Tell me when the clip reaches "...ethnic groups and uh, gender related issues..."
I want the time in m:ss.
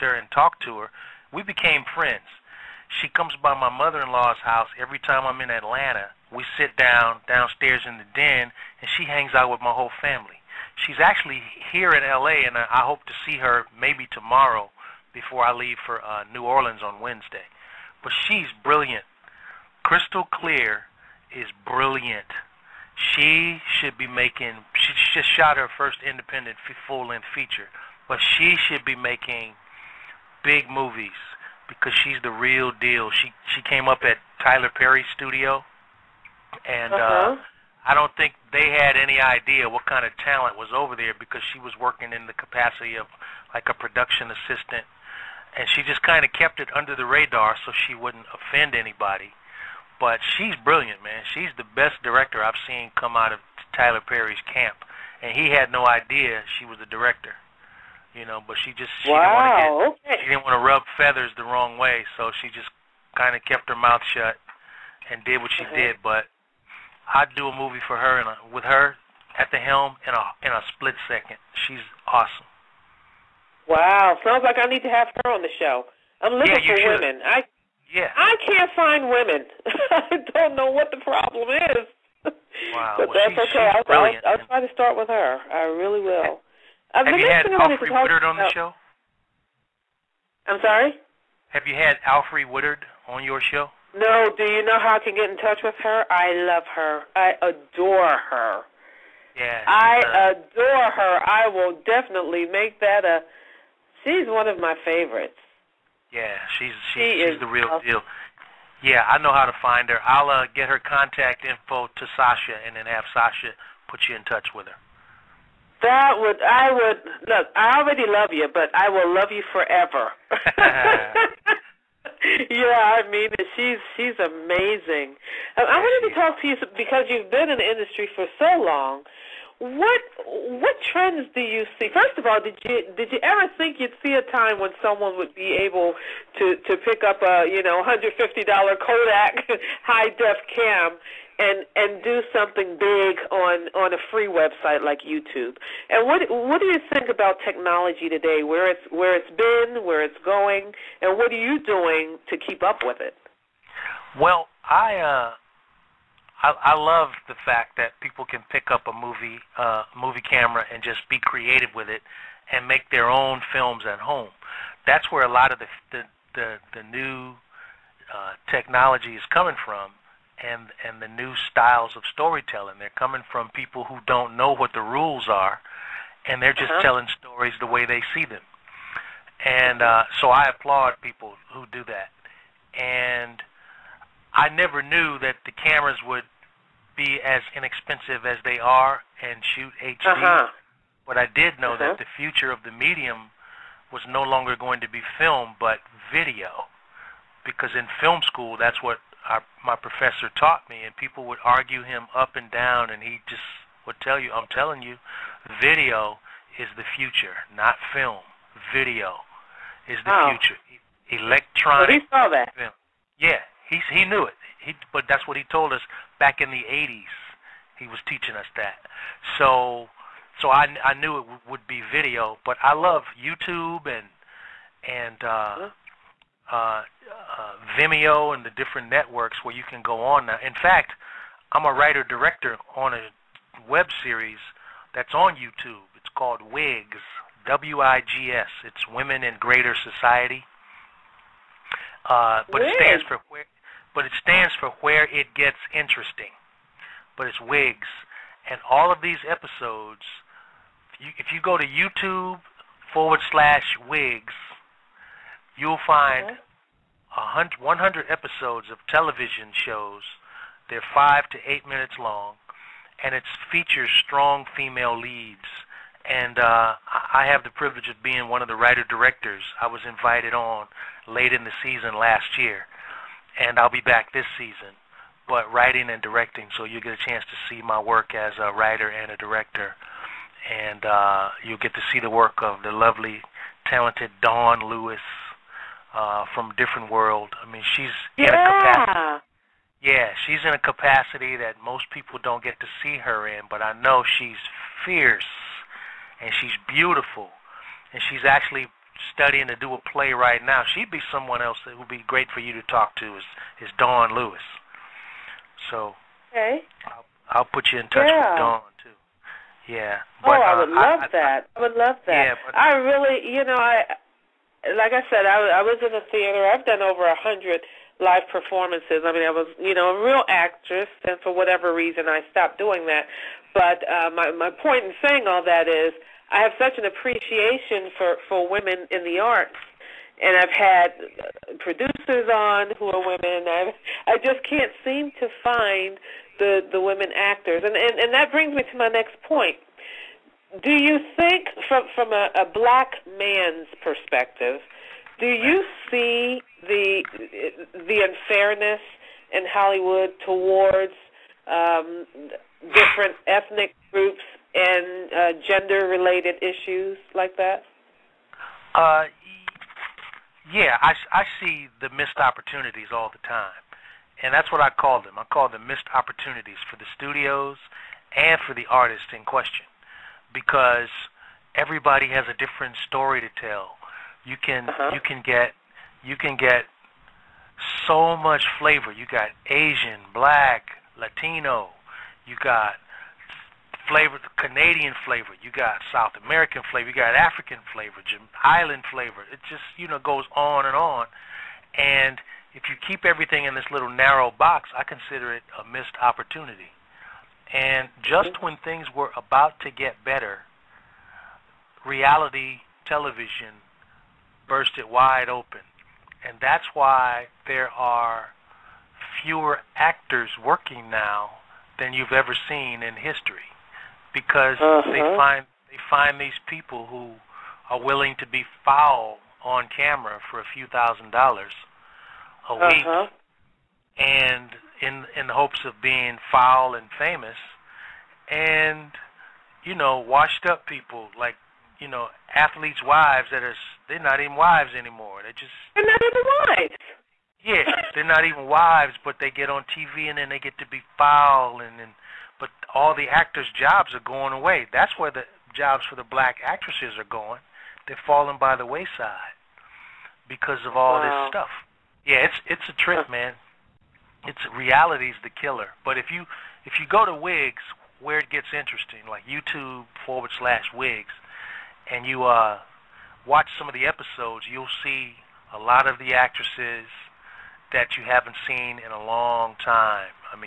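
5:53.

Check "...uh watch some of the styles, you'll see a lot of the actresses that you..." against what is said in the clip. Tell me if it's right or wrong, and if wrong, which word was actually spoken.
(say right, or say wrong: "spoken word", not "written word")
wrong: "episodes", not "styles".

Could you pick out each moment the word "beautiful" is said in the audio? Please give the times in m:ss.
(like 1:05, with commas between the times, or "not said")
4:56.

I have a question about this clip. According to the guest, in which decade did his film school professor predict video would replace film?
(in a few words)
the 80s.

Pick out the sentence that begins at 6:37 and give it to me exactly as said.
And just when things were about to get better, reality television burst it wide open.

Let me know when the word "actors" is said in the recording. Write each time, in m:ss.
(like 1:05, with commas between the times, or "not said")
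5:37, 6:49, 7:23.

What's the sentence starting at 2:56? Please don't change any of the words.
telling stories the way they see them.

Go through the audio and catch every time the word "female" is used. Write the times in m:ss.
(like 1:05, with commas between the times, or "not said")
4:24.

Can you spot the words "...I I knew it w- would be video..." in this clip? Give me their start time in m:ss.
3:40.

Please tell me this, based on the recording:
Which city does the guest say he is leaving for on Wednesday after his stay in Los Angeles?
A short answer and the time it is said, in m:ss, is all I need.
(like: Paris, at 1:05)
New Orleans, at 0:16.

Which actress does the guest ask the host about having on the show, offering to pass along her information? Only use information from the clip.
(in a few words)
Alfre Woodard.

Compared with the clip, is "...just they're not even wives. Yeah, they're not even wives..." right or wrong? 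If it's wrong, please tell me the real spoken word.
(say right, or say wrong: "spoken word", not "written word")
right.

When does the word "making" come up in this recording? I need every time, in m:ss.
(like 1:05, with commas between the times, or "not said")
0:24, 0:28.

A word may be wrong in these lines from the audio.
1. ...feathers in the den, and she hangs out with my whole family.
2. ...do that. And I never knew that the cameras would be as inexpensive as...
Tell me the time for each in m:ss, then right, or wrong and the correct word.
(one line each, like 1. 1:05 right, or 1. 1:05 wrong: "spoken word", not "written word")
1. 0:07 wrong: "downstairs", not "feathers"
2. 3:01 right.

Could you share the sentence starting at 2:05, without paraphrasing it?
I wanted to talk to you because you've been in the industry for so long what what trends do you see?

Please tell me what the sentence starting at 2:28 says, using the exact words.
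Where it's where it's been, where it's going, and what are you doing to keep up with it?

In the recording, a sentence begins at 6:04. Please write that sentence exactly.
And that's what I call them.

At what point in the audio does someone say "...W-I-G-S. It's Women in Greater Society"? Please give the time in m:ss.
3:57.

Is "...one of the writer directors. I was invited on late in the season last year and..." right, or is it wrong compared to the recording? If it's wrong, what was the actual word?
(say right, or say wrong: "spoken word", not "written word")
right.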